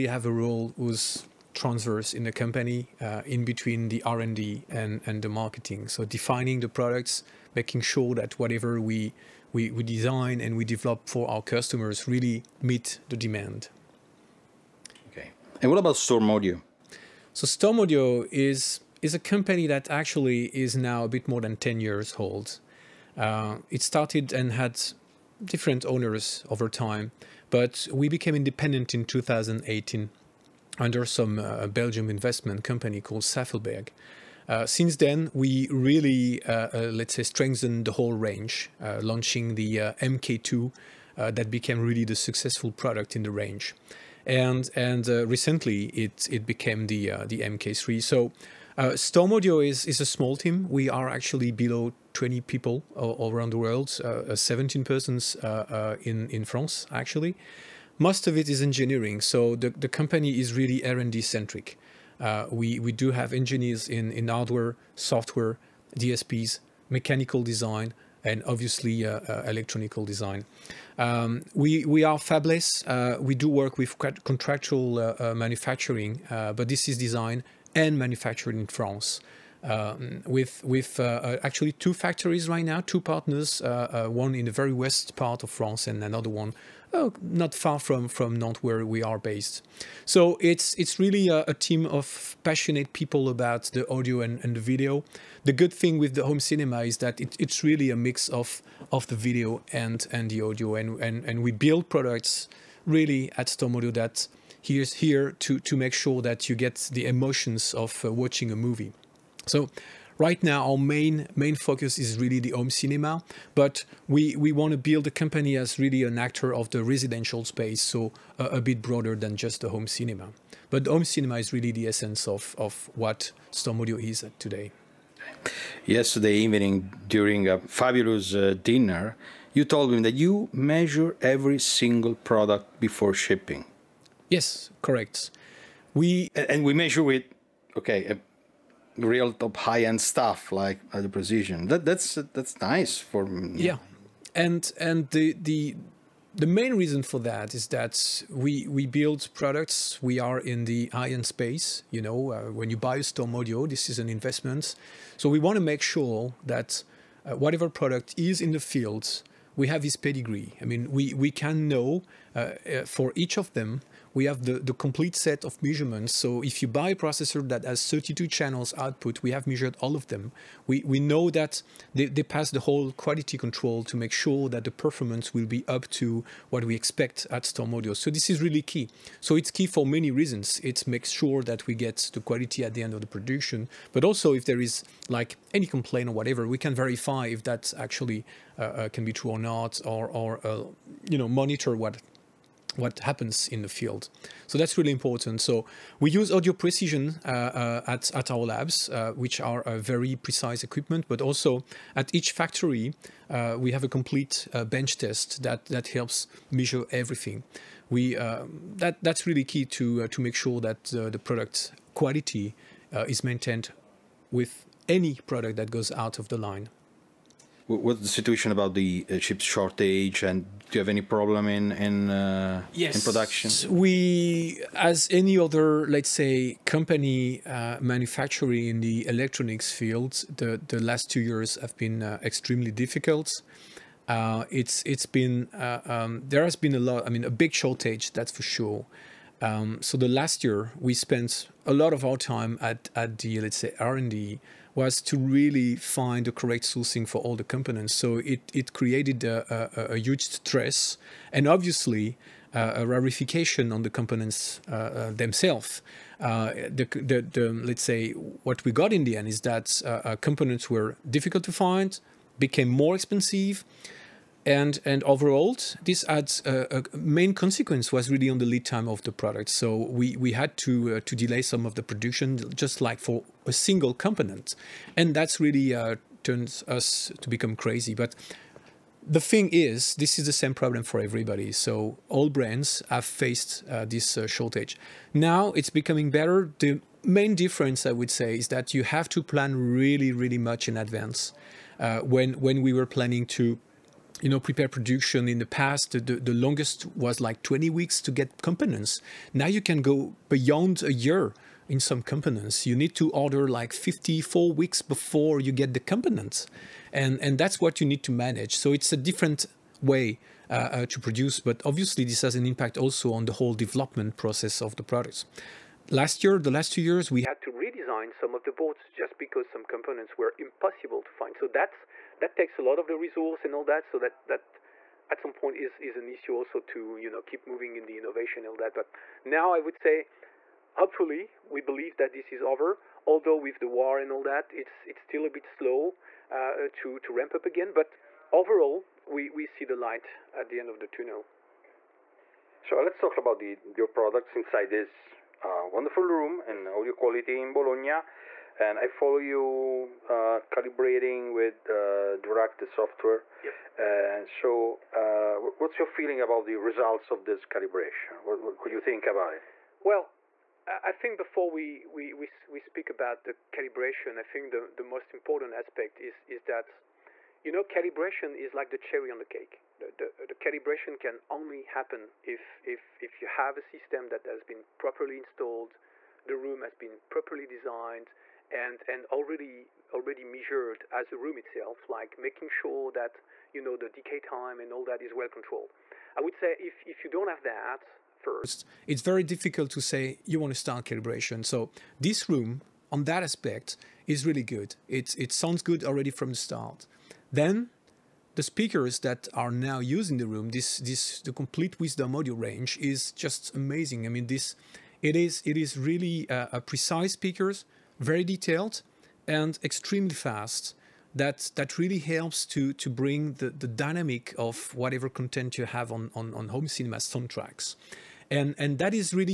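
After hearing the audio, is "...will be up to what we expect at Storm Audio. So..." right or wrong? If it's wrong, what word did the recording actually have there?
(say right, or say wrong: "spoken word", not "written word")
right.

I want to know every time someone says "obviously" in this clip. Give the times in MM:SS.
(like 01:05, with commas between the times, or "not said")
01:08, 04:11, 05:11.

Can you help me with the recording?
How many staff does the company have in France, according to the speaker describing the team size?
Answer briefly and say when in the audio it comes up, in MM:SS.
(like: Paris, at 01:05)
17, at 00:54.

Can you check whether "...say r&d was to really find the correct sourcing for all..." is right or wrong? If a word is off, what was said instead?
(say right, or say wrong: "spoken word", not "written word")
right.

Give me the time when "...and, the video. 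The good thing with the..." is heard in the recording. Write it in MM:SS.
01:34.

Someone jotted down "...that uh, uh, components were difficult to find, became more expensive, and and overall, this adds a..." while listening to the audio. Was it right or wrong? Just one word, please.
right.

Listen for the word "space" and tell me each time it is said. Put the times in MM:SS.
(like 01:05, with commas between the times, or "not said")
01:57, 02:31.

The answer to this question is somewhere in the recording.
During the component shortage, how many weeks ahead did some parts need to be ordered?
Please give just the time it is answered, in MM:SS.
05:03.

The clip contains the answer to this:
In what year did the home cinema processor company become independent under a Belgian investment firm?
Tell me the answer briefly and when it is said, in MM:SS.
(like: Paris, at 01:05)
2018, at 00:29.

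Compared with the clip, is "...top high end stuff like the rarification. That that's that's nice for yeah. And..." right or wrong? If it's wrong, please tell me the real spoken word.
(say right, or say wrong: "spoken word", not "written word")
wrong: "precision", not "rarification".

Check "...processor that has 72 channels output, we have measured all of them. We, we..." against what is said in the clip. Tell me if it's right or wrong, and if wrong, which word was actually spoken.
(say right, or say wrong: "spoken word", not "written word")
wrong: "32", not "72".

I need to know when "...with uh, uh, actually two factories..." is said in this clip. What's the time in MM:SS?
01:20.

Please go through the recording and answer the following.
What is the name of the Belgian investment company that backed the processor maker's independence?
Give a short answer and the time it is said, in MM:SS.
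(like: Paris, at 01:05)
Saffelberg, at 00:33.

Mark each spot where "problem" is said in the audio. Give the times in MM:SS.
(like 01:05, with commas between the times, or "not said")
03:41, 04:40.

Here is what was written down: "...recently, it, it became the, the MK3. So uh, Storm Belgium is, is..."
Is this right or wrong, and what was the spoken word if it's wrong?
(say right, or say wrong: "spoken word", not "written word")
wrong: "Audio", not "Belgium".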